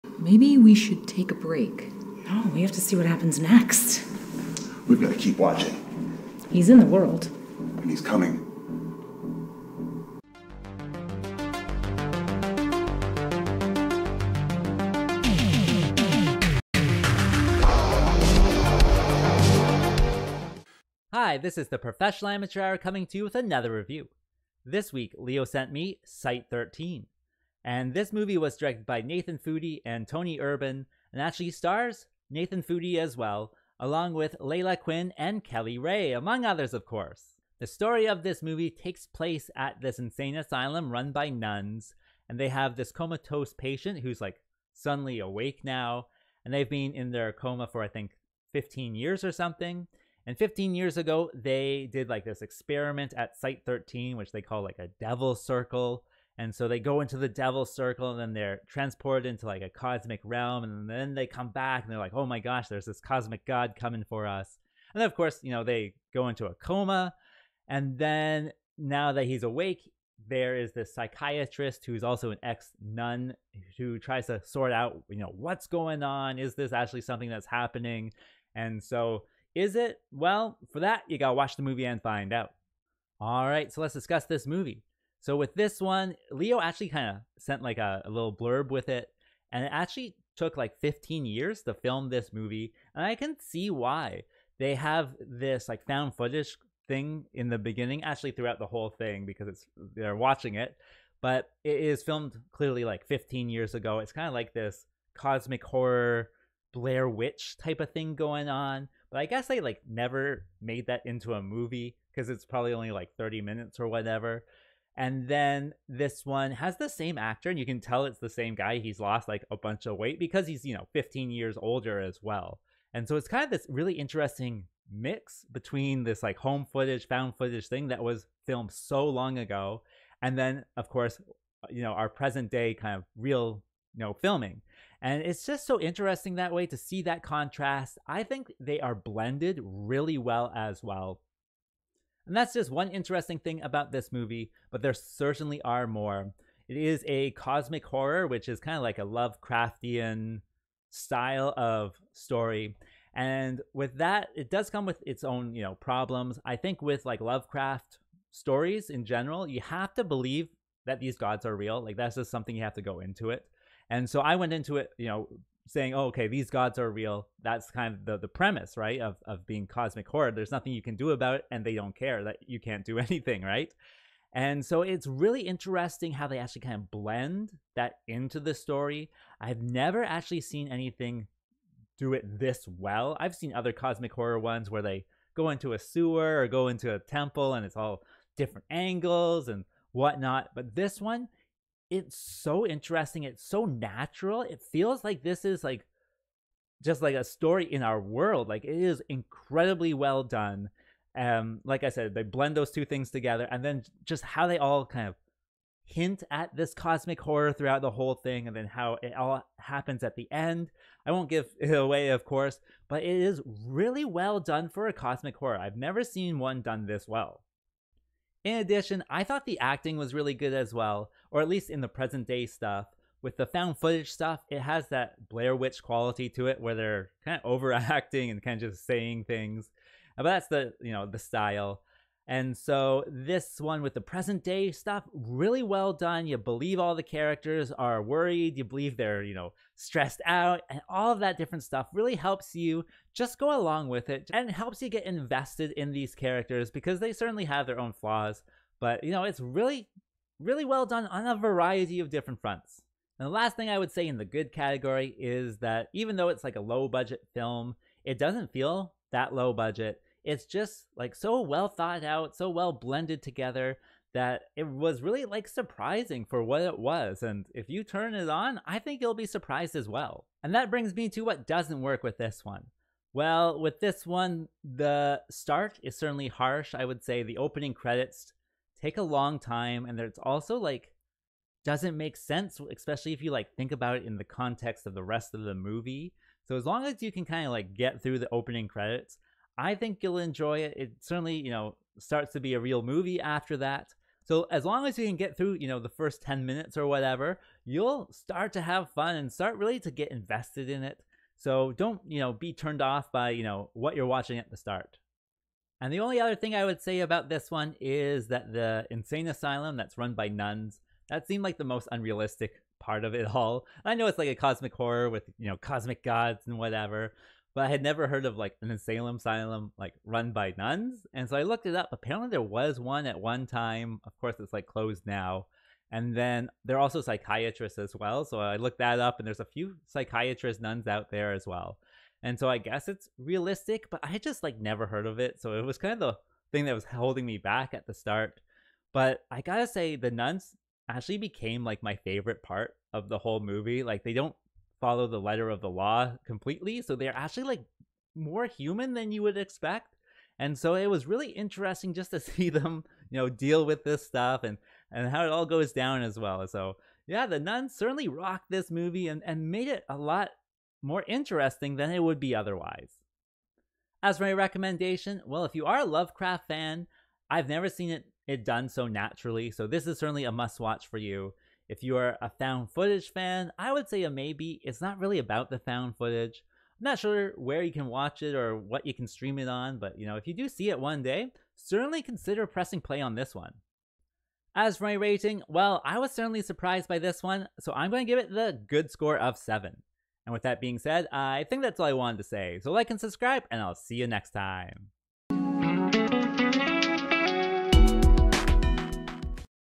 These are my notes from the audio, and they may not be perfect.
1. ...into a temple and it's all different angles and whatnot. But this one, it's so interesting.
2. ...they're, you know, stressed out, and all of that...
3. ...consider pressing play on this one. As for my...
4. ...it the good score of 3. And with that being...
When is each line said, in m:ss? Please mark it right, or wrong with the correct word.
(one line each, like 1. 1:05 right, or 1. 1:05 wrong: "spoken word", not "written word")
1. 3:06 right
2. 3:58 right
3. 6:22 right
4. 6:28 wrong: "7", not "3".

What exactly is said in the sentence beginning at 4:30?
And that brings me to what doesn't work with this one.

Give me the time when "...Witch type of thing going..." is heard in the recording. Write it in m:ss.
1:47.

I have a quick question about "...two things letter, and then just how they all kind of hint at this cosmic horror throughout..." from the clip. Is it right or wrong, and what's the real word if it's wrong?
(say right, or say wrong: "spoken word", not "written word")
wrong: "together", not "letter".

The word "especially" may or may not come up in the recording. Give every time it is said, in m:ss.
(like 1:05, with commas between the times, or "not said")
4:42.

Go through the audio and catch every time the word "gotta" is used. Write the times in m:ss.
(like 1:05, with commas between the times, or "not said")
1:21, 5:39.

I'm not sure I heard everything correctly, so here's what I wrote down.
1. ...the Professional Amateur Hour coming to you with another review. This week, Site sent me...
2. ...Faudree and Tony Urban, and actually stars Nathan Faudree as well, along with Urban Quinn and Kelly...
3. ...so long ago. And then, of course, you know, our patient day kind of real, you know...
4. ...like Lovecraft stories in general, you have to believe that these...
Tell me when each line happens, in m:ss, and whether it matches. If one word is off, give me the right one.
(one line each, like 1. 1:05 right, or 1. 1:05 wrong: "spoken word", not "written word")
1. 0:21 wrong: "Leo", not "Site"
2. 0:29 wrong: "Layla", not "Urban"
3. 2:08 wrong: "present", not "patient"
4. 2:37 right.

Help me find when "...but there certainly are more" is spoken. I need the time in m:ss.
2:24.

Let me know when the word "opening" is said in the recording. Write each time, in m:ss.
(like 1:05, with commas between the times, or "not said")
4:37, 4:48.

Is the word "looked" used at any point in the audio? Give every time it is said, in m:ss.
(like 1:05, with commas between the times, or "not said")
5:21, 5:28.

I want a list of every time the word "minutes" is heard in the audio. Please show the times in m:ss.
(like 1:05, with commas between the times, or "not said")
1:53, 4:56.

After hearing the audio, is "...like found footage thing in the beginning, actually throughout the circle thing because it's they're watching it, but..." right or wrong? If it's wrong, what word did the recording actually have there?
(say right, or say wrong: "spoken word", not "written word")
wrong: "whole", not "circle".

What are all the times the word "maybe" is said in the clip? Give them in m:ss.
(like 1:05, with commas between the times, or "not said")
0:00, 6:14.